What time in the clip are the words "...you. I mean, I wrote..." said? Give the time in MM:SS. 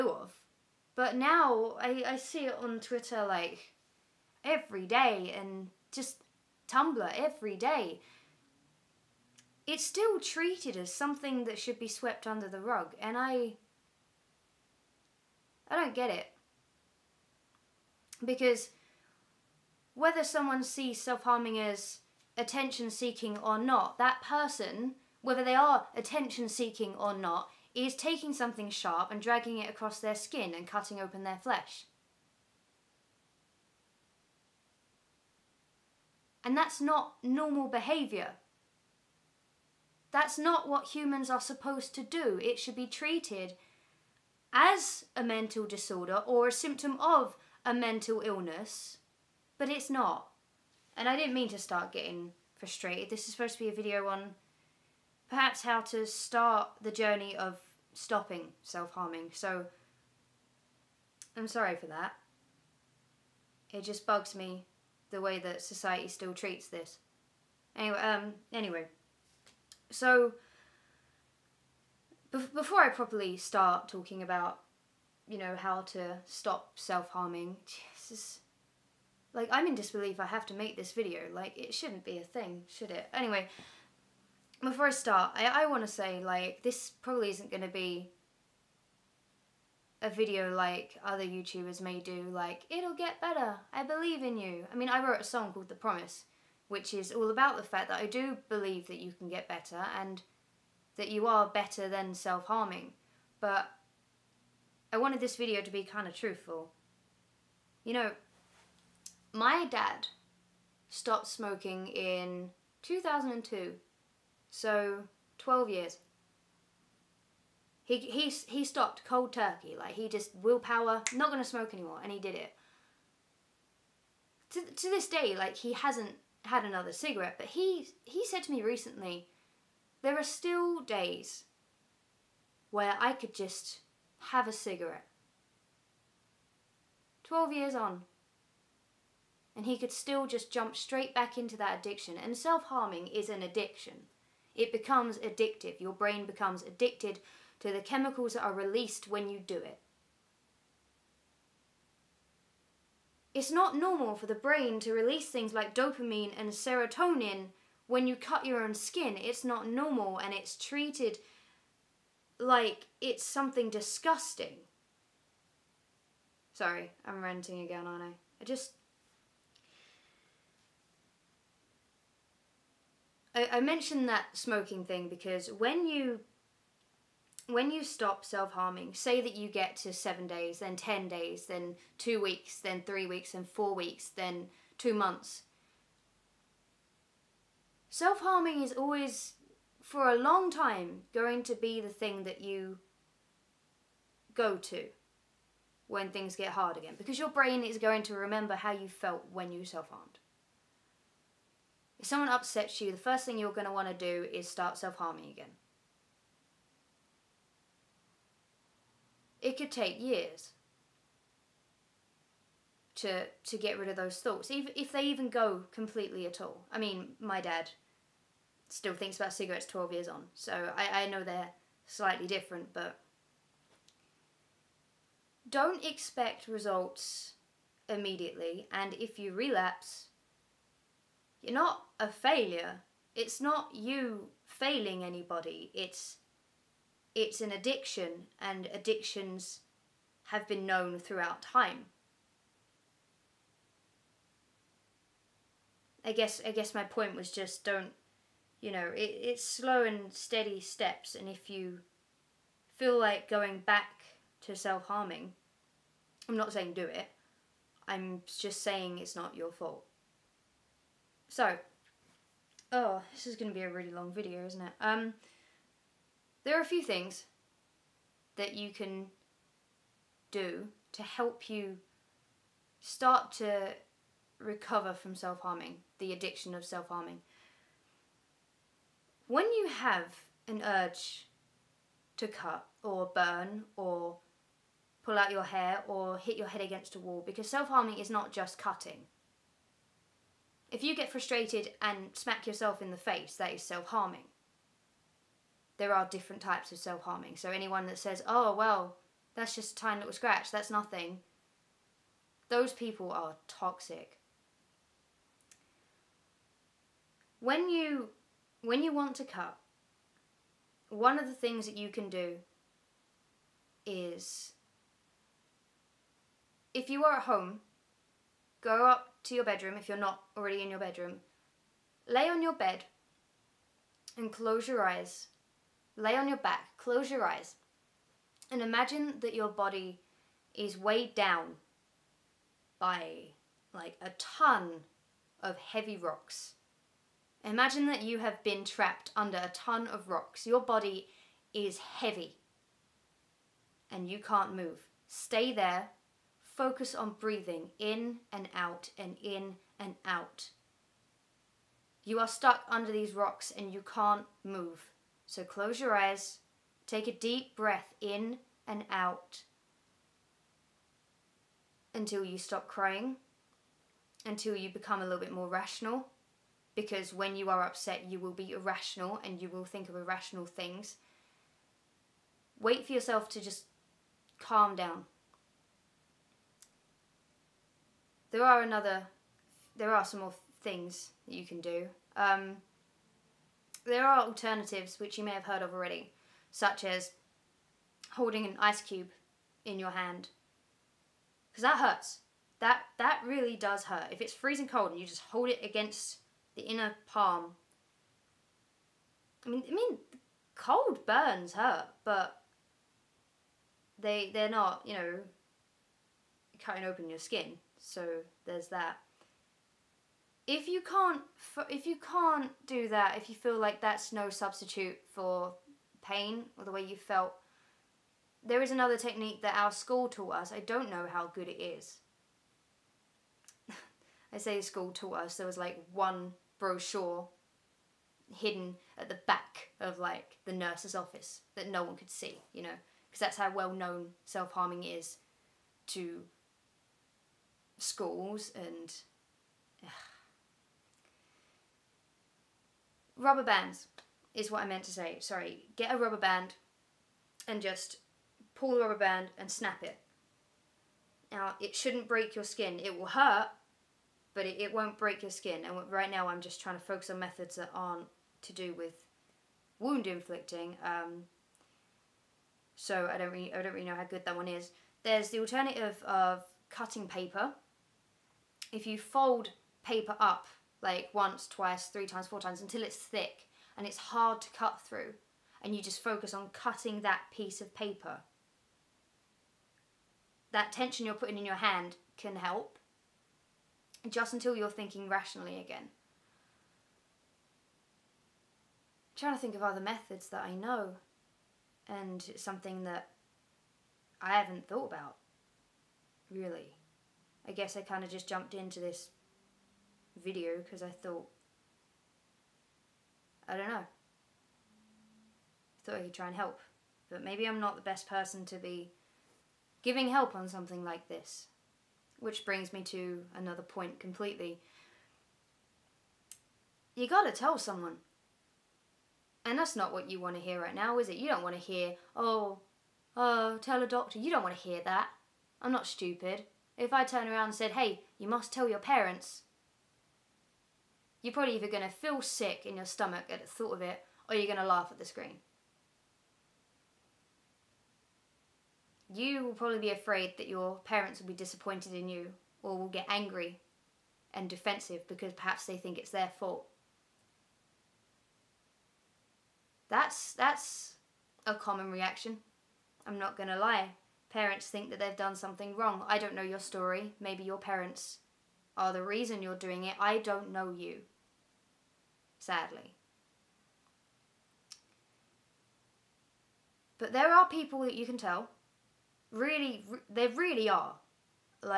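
01:34.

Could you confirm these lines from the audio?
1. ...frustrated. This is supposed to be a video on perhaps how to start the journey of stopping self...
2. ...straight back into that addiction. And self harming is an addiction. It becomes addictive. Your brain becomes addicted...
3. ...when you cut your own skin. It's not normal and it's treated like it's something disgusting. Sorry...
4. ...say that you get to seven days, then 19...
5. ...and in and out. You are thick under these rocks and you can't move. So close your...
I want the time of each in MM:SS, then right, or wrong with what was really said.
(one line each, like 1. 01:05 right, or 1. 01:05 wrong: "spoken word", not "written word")
1. 00:52 right
2. 02:20 right
3. 02:37 right
4. 02:58 wrong: "10", not "19"
5. 05:48 wrong: "stuck", not "thick".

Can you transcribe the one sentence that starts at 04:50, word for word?
If you get frustrated and smack yourself in the face, that is self harming.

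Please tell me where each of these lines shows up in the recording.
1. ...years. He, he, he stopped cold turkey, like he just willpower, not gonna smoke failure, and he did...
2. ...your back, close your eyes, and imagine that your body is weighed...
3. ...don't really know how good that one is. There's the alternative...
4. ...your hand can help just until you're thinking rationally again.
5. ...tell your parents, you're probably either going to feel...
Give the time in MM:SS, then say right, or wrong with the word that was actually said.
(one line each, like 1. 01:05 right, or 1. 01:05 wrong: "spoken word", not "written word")
1. 01:55 wrong: "anymore", not "failure"
2. 05:26 right
3. 07:43 right
4. 08:01 right
5. 08:48 right.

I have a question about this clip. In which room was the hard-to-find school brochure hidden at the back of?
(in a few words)
the nurse's office.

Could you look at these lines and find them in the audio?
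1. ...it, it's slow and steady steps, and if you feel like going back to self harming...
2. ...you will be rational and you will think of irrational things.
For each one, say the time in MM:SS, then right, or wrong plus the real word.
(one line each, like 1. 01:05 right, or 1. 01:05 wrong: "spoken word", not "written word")
1. 04:08 right
2. 06:08 wrong: "irrational", not "rational".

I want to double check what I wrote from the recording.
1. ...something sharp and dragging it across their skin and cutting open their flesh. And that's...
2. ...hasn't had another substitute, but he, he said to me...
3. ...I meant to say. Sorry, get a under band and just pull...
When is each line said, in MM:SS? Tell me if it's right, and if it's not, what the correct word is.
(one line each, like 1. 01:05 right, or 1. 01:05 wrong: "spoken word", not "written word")
1. 00:28 right
2. 02:05 wrong: "cigarette", not "substitute"
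3. 07:24 wrong: "rubber", not "under".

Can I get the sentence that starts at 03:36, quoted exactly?
I mean, my dad still thinks about cigarettes 12 years on.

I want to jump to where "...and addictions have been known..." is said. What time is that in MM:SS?
03:58.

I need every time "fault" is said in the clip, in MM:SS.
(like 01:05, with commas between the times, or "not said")
04:19, 09:06.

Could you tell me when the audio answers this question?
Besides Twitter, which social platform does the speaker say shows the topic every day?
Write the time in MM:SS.
00:06.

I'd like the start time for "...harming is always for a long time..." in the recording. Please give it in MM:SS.
03:08.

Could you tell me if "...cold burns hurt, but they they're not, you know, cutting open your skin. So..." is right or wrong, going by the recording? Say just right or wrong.
right.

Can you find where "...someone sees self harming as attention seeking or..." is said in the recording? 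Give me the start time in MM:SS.
00:20.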